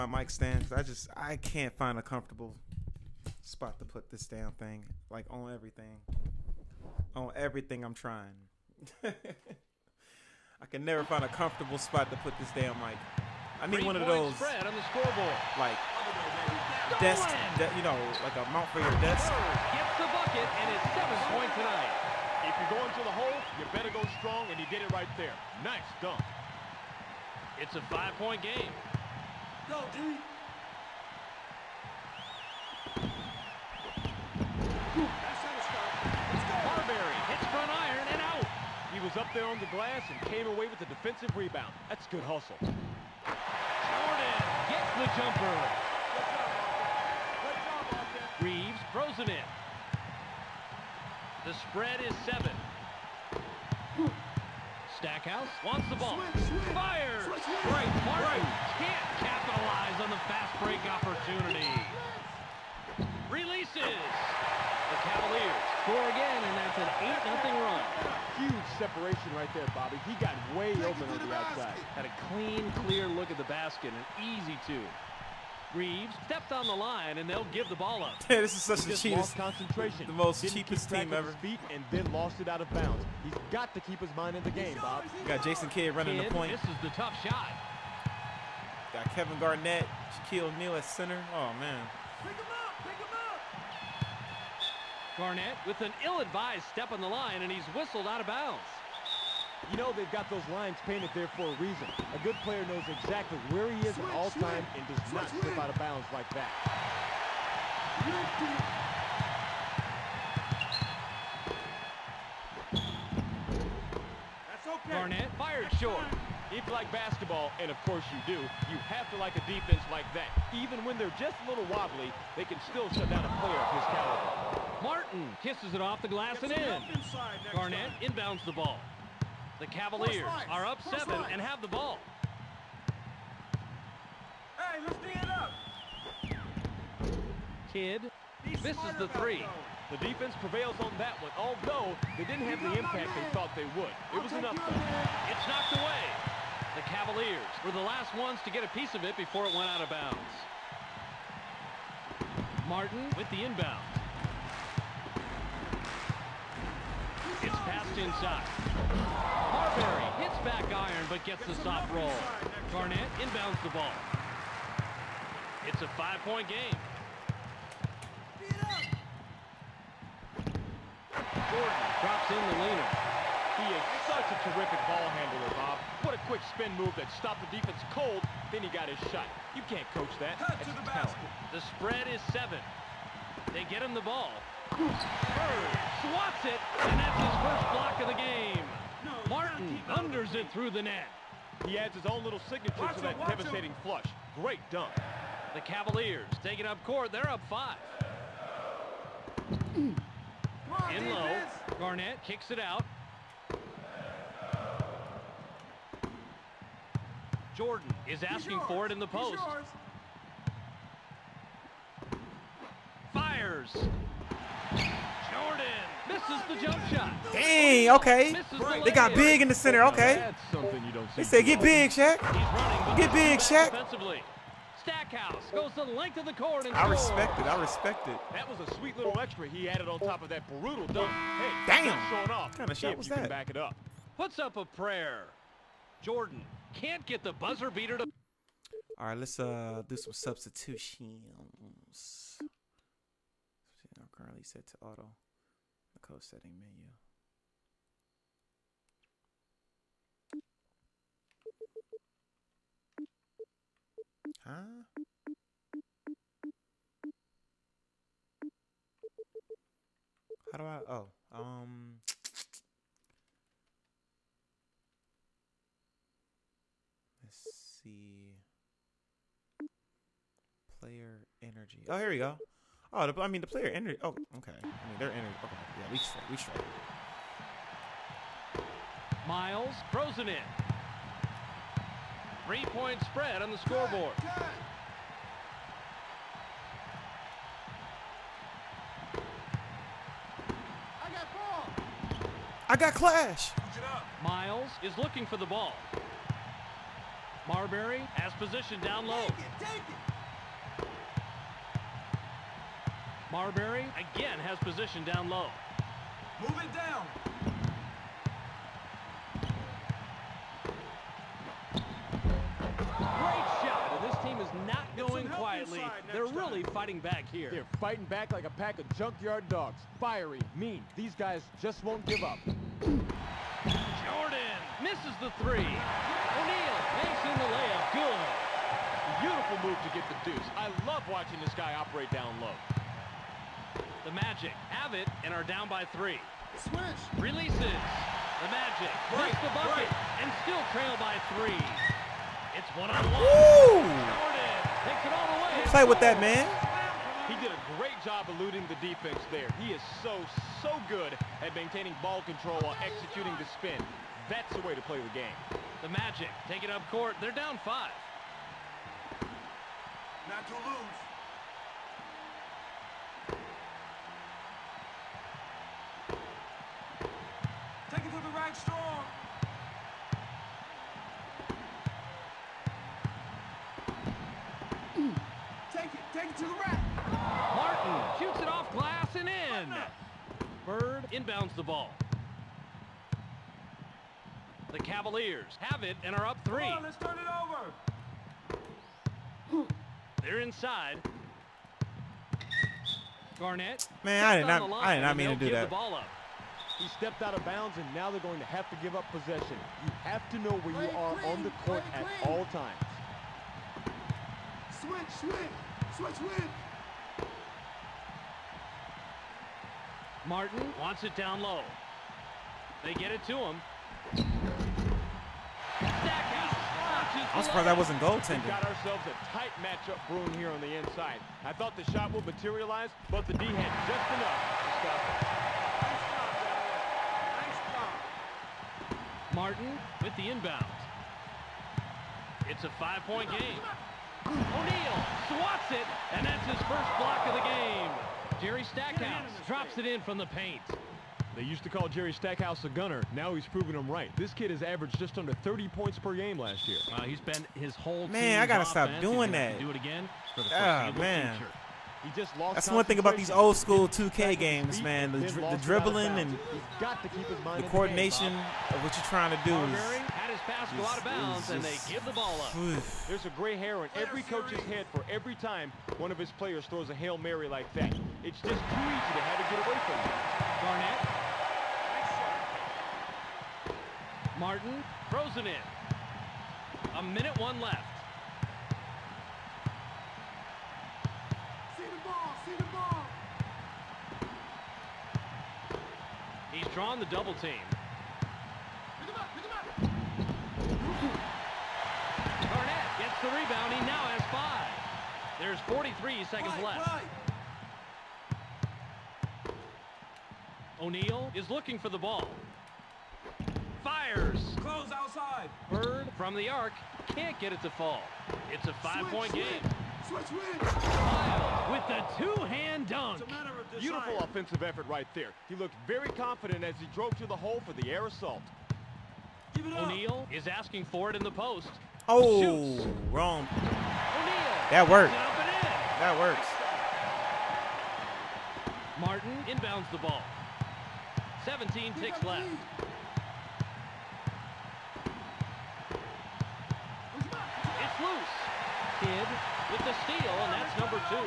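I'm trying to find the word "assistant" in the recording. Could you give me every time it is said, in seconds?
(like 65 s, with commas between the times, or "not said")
not said.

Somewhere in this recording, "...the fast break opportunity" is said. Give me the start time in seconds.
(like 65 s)
60 s.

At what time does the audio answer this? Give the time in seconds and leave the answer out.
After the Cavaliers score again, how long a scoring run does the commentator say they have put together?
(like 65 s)
67 s.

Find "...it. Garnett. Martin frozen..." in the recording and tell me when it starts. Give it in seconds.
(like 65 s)
474 s.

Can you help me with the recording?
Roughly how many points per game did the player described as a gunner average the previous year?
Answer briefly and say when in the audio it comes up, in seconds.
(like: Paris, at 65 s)
Just under 30, at 444 s.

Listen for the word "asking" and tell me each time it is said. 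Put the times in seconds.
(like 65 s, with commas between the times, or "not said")
208 s, 520 s.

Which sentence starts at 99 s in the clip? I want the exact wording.
You know they've got those lines painted there for a reason.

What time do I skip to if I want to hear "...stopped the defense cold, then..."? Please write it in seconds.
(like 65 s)
177 s.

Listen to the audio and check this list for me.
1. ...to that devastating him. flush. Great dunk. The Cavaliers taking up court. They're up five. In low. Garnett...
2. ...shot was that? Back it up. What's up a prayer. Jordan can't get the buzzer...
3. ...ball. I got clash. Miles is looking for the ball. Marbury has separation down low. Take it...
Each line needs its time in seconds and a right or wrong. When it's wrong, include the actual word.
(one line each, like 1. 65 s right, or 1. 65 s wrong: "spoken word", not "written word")
1. 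192 s right
2. 232 s right
3. 291 s wrong: "position", not "separation".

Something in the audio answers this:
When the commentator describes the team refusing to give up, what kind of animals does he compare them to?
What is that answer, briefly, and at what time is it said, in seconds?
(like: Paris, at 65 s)
Junkyard dogs, at 318 s.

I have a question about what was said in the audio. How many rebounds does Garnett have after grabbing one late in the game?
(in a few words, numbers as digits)
5.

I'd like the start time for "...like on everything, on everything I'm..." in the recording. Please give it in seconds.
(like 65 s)
5 s.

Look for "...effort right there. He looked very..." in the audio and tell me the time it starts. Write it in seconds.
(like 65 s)
514 s.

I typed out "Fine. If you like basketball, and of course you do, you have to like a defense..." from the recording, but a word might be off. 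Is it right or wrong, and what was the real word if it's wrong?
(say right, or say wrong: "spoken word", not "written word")
right.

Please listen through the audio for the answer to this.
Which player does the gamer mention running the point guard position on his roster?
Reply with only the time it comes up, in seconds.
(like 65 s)
85 s.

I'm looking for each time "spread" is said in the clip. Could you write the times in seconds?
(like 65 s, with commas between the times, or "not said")
14 s, 51 s, 181 s, 283 s.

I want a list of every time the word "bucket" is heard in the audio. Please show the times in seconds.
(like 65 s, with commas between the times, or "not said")
20 s, 339 s.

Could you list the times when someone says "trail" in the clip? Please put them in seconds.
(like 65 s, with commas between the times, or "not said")
340 s.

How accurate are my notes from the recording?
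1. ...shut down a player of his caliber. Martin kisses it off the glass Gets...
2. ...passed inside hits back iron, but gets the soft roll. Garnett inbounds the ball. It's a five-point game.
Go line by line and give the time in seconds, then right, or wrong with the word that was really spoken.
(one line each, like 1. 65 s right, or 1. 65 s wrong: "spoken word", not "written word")
1. 122 s right
2. 157 s right.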